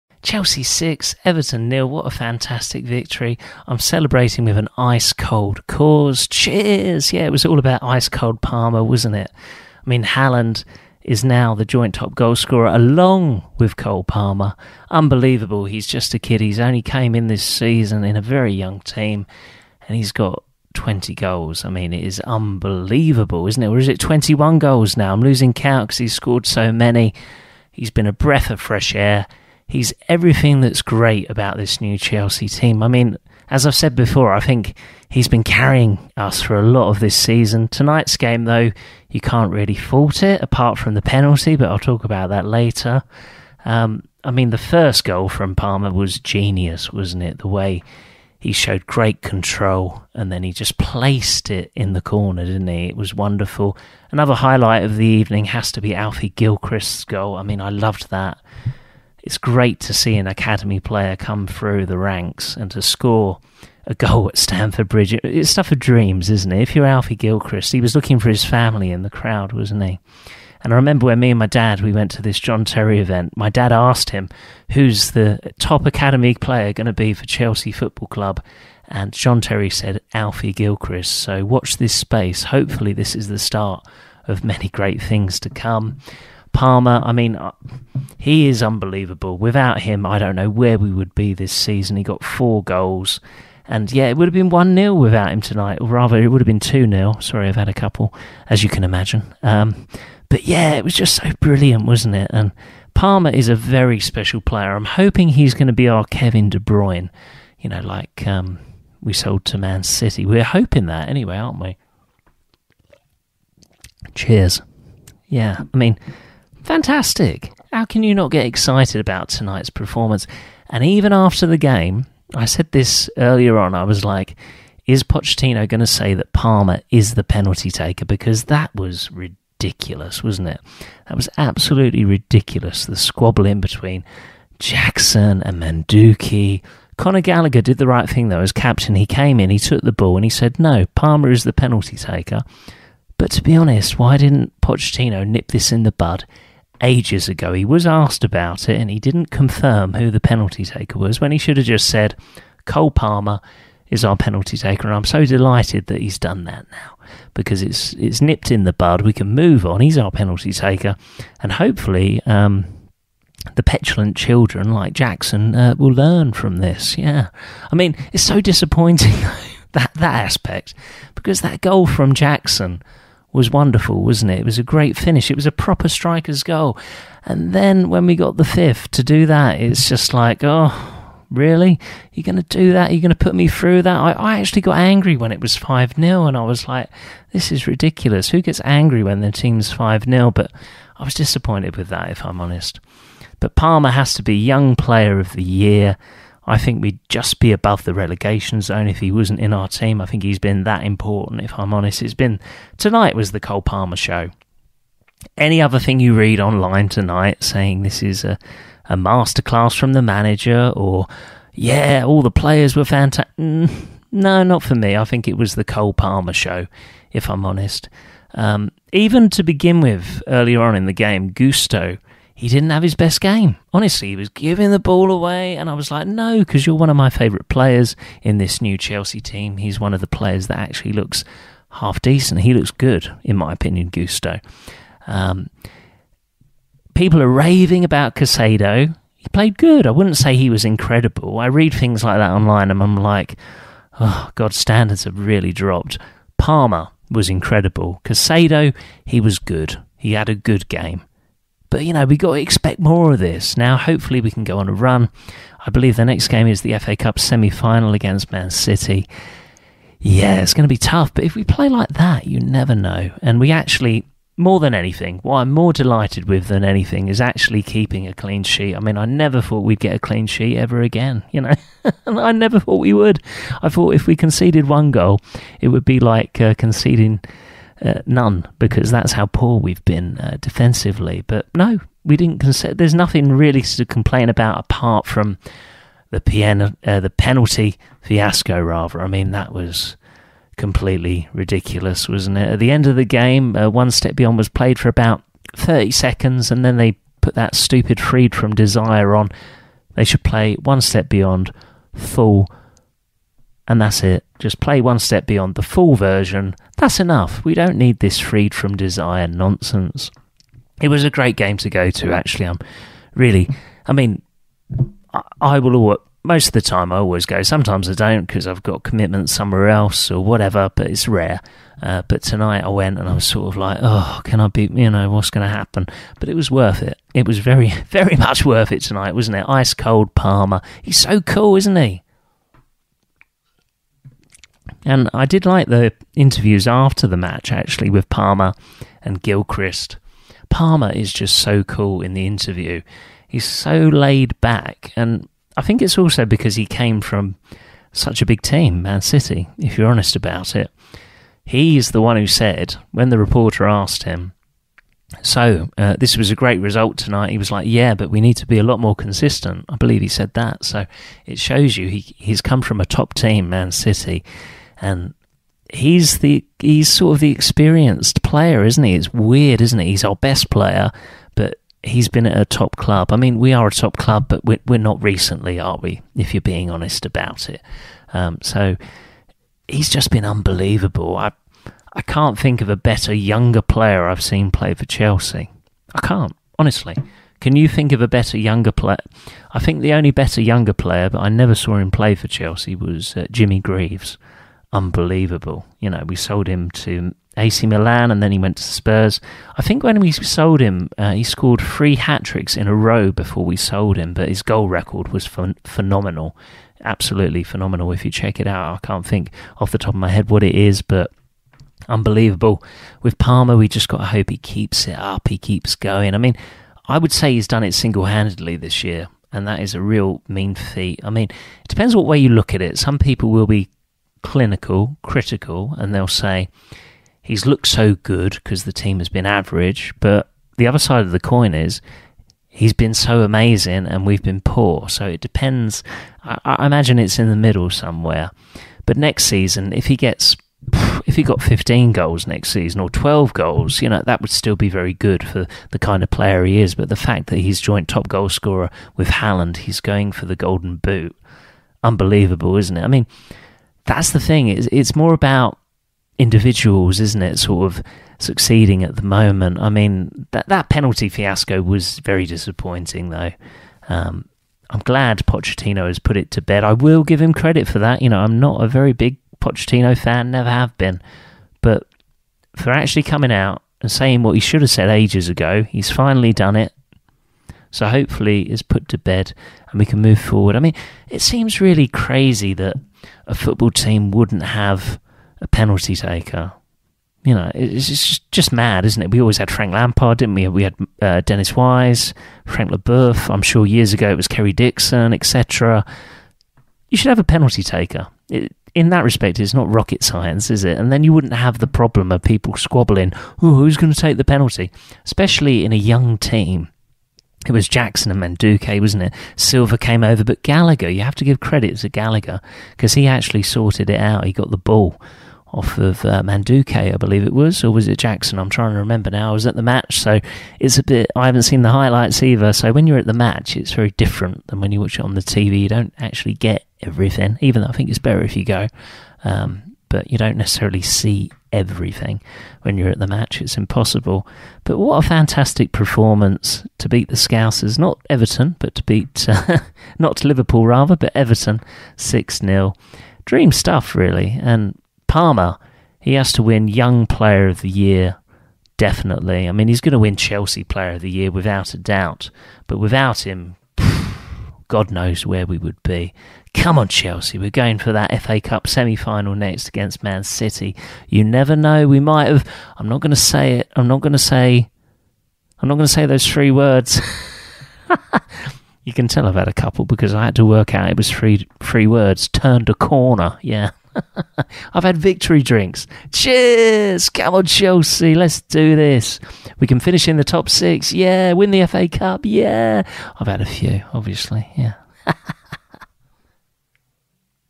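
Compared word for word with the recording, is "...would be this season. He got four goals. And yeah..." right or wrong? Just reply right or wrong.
right.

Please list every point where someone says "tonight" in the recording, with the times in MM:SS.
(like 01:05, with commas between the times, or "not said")
00:37, 01:35, 01:59, 03:22, 03:26, 05:22, 05:28, 05:56.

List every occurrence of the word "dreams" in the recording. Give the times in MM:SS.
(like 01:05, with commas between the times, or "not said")
01:05, 09:03.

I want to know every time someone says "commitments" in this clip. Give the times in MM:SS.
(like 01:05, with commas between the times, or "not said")
05:18.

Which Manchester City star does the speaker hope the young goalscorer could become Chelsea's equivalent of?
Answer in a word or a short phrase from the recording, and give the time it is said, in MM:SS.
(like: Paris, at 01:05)
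Kevin De Bruyne, at 01:46.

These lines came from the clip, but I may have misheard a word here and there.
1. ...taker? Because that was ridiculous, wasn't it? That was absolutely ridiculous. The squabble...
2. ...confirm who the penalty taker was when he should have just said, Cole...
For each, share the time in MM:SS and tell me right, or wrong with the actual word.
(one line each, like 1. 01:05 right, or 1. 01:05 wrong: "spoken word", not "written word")
1. 02:07 right
2. 02:29 right.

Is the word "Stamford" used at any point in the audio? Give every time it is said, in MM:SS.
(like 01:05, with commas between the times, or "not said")
01:04.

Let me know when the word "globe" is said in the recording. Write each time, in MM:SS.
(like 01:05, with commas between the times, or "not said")
not said.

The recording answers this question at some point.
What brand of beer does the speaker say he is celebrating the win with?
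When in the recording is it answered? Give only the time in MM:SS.
00:05.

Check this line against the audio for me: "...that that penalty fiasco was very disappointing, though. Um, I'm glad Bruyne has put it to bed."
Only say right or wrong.
wrong.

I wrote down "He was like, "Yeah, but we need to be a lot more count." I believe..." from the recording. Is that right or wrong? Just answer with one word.
wrong.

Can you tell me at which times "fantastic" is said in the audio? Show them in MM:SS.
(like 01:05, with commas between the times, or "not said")
00:02, 01:56, 03:32, 08:55.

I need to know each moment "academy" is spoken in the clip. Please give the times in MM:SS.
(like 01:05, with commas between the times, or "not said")
01:00, 01:15.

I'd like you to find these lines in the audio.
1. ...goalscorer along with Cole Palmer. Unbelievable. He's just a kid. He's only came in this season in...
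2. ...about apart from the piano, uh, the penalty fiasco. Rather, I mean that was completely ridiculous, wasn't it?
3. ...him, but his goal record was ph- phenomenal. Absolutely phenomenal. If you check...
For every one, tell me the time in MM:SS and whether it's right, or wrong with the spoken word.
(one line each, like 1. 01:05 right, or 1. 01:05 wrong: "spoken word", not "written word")
1. 00:12 right
2. 04:44 right
3. 06:43 right.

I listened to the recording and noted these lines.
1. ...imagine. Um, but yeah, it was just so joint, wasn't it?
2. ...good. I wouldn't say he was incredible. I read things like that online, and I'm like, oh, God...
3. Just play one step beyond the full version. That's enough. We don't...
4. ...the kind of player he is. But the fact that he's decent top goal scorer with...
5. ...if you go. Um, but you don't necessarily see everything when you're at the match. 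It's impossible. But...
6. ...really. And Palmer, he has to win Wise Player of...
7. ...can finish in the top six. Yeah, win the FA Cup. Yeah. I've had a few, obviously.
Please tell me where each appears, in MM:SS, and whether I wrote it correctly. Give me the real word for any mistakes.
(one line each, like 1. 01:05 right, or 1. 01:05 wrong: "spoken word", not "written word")
1. 01:38 wrong: "brilliant", not "joint"
2. 03:59 right
3. 05:04 right
4. 07:25 wrong: "joint", not "decent"
5. 08:48 right
6. 09:03 wrong: "Young", not "Wise"
7. 09:39 right.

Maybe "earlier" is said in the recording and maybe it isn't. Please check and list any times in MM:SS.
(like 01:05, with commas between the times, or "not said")
02:03, 03:40.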